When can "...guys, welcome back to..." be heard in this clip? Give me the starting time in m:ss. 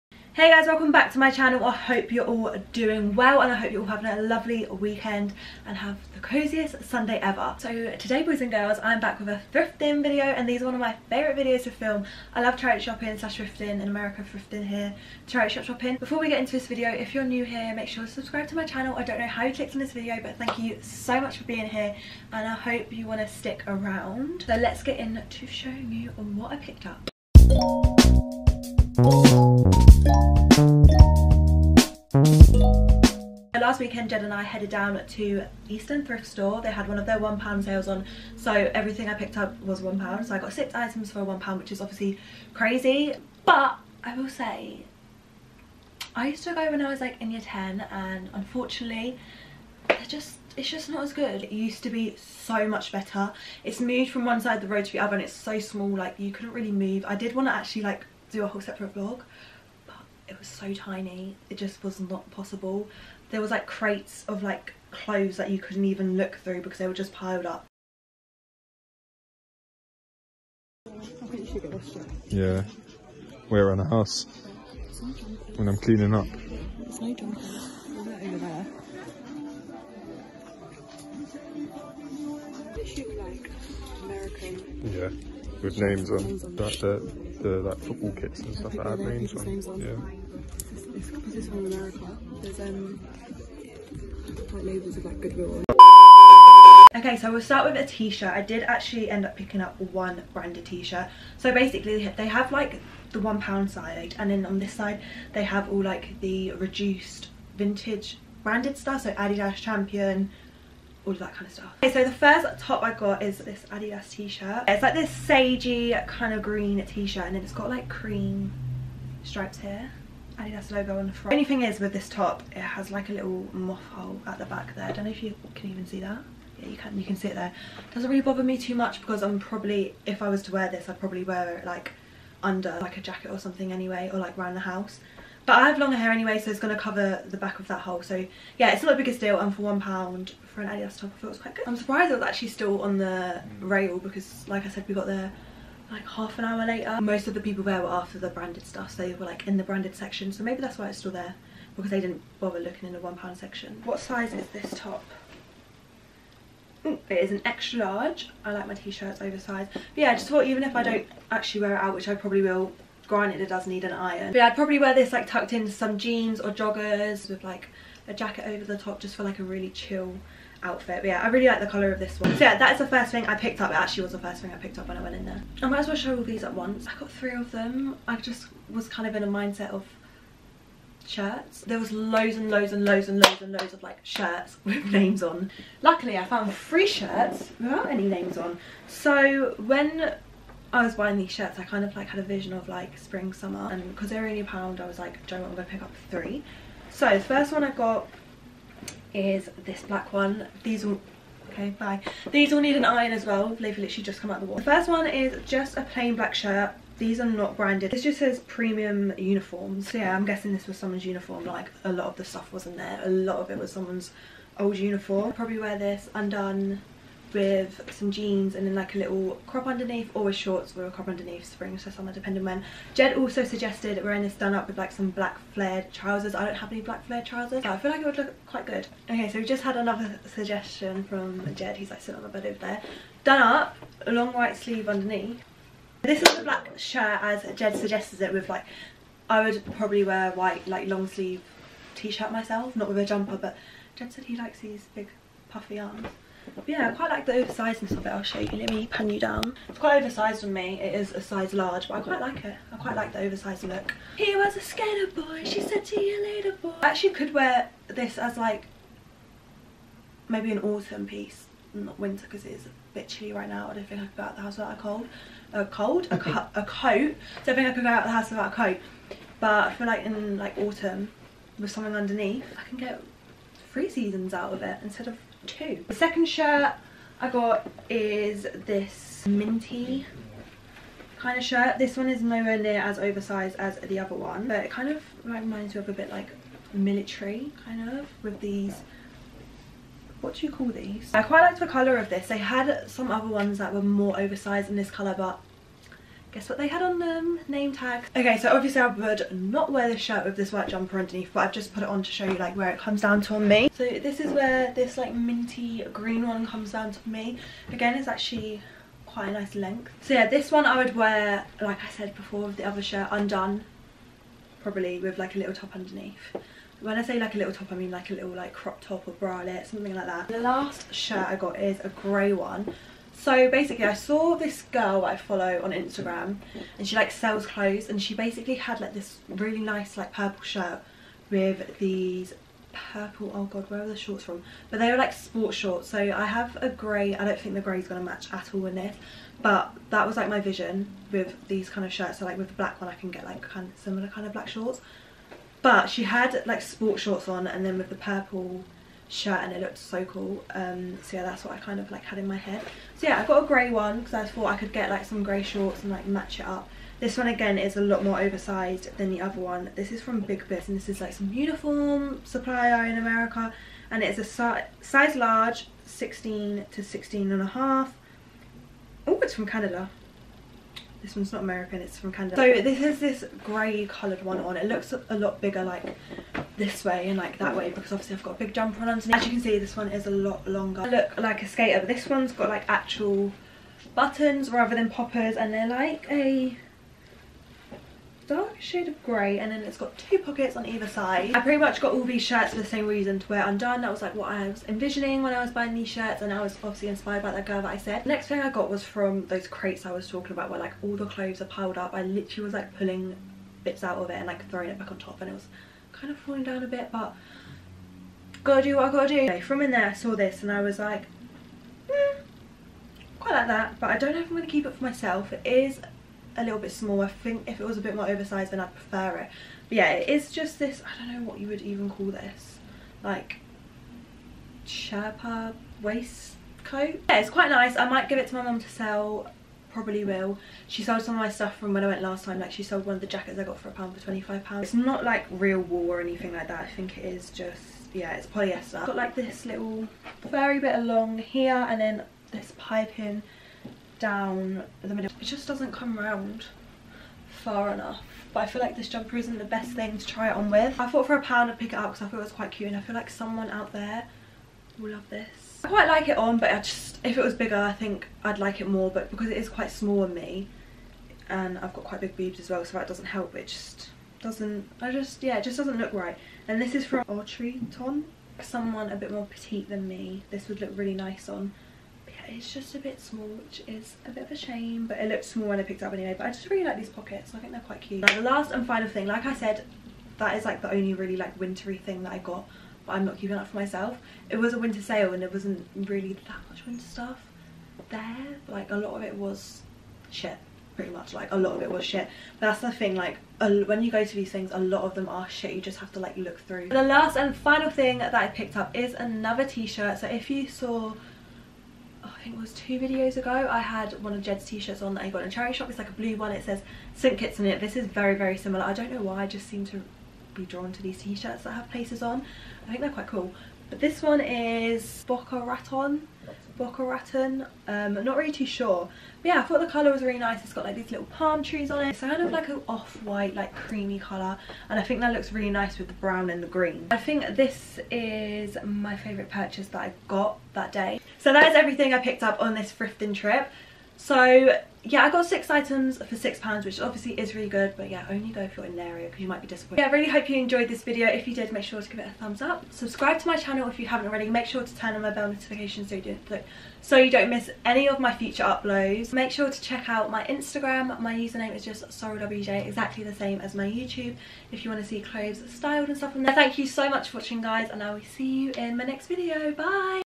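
0:00.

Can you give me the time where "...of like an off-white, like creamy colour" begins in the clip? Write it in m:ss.
8:42.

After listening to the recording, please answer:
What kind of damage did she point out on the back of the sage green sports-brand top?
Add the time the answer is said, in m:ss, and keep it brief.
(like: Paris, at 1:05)
Moth hole, at 2:03.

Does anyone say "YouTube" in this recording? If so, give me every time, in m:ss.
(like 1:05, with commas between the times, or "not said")
9:13.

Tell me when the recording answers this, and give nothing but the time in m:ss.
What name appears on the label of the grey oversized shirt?
6:00.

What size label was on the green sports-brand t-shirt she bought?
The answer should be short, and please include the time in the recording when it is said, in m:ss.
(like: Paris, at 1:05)
Extra large, at 2:37.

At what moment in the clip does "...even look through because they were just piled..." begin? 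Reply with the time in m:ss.
1:05.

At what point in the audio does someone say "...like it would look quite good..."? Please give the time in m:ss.
3:47.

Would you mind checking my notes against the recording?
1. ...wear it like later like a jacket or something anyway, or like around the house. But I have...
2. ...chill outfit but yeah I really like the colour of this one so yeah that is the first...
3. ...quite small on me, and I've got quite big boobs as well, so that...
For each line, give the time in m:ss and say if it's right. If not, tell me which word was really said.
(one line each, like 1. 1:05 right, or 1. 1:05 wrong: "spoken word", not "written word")
1. 2:11 wrong: "under", not "later"
2. 2:49 right
3. 7:39 right.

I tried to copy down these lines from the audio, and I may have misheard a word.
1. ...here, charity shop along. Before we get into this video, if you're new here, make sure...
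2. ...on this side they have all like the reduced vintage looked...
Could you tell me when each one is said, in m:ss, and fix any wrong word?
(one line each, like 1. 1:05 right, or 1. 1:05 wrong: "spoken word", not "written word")
1. 0:14 wrong: "shopping", not "along"
2. 1:44 wrong: "branded", not "looked".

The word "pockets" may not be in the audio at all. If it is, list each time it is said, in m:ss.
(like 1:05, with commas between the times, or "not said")
6:30, 7:56.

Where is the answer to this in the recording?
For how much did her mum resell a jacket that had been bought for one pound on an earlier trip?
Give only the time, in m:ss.
7:14.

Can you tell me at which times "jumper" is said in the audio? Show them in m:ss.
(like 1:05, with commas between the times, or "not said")
4:03, 5:00, 6:18, 7:28.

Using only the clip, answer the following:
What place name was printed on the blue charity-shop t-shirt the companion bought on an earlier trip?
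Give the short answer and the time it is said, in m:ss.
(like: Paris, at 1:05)
St Kitts, at 8:26.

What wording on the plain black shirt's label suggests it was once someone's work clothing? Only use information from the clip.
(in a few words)
Premium uniforms.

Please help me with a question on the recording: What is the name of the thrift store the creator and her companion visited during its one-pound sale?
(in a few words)
East End Thrift Store.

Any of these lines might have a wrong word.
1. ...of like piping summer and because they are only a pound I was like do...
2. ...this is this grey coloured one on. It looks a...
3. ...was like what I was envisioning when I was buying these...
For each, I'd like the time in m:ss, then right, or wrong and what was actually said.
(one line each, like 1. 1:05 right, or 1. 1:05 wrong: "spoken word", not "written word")
1. 3:12 wrong: "spring", not "piping"
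2. 6:12 right
3. 6:33 right.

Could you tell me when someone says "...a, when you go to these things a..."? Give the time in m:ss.
8:13.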